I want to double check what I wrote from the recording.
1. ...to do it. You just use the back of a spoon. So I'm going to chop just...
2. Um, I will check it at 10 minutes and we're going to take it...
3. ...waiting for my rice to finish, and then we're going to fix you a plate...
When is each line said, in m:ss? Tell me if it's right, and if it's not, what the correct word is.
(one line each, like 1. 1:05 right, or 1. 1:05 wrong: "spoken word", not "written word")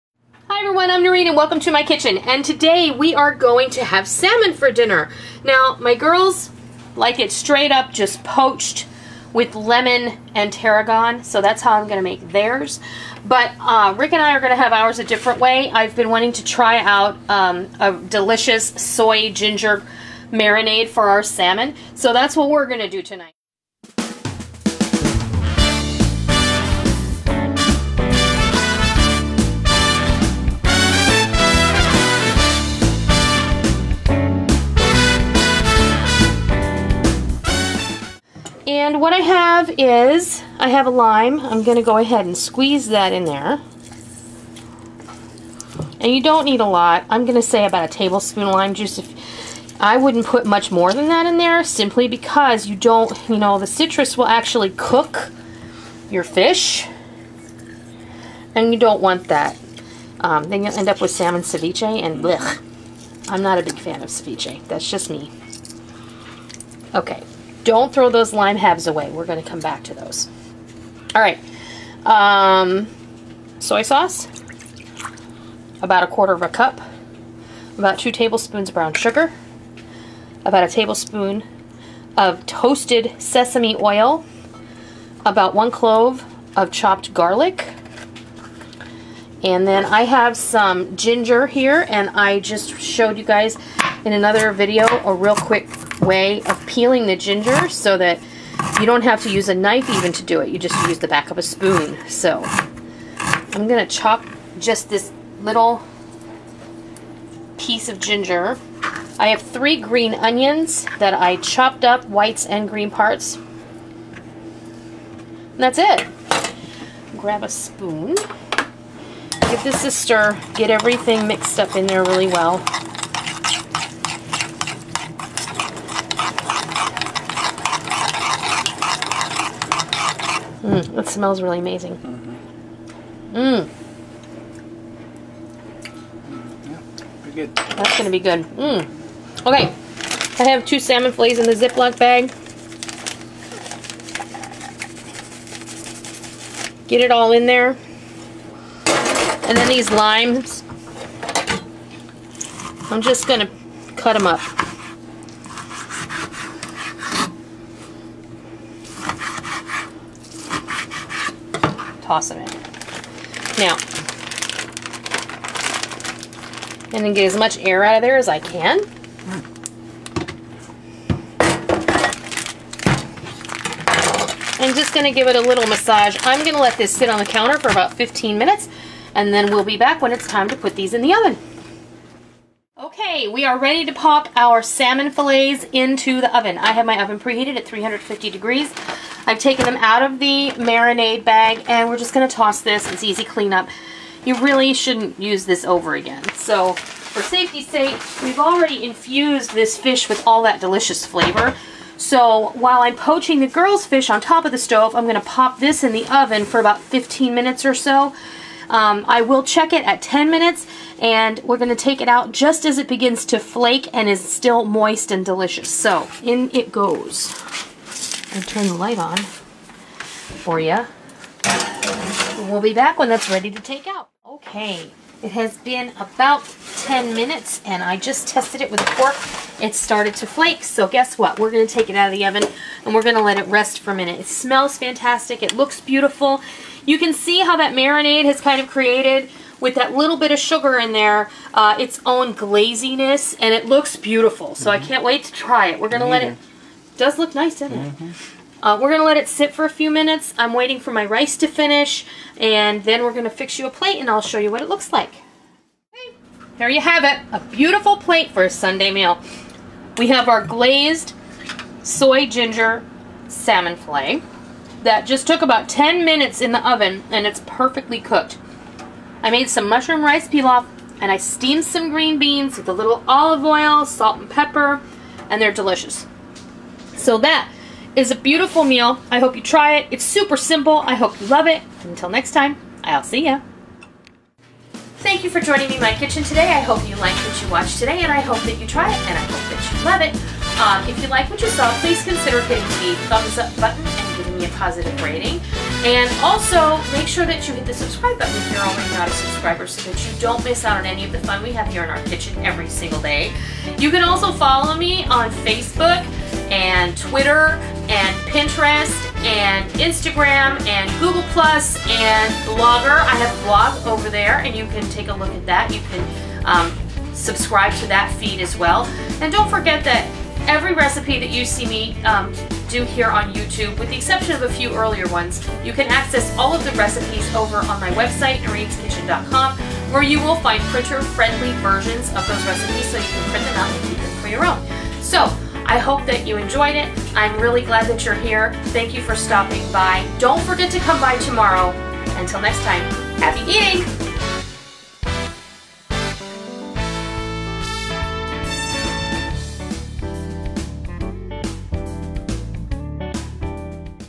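1. 1:40 right
2. 3:28 right
3. 4:10 right.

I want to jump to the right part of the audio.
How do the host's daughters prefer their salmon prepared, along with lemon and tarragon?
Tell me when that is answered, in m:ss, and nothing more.
0:08.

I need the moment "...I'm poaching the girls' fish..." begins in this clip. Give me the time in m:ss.
3:22.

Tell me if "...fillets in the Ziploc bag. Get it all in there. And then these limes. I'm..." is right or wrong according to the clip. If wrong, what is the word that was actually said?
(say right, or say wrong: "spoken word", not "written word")
right.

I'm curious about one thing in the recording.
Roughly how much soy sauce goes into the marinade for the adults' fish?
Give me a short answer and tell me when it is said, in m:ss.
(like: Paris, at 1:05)
a quarter of a cup, at 1:16.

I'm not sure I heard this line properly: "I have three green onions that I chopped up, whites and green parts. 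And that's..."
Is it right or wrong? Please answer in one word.
right.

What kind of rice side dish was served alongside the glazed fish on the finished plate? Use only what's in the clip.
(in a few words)
mushroom rice pilaf.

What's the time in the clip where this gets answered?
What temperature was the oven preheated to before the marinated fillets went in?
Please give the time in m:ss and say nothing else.
3:07.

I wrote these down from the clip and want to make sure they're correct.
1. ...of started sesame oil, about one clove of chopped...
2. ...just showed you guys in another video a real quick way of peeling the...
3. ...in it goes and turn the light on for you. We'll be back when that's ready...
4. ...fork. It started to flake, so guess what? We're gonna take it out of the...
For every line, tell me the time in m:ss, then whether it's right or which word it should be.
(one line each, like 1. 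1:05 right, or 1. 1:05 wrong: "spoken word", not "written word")
1. 1:22 wrong: "toasted", not "started"
2. 1:32 right
3. 3:36 right
4. 3:48 right.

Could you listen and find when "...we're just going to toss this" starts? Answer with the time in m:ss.
3:11.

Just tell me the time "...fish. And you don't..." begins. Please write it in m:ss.
0:56.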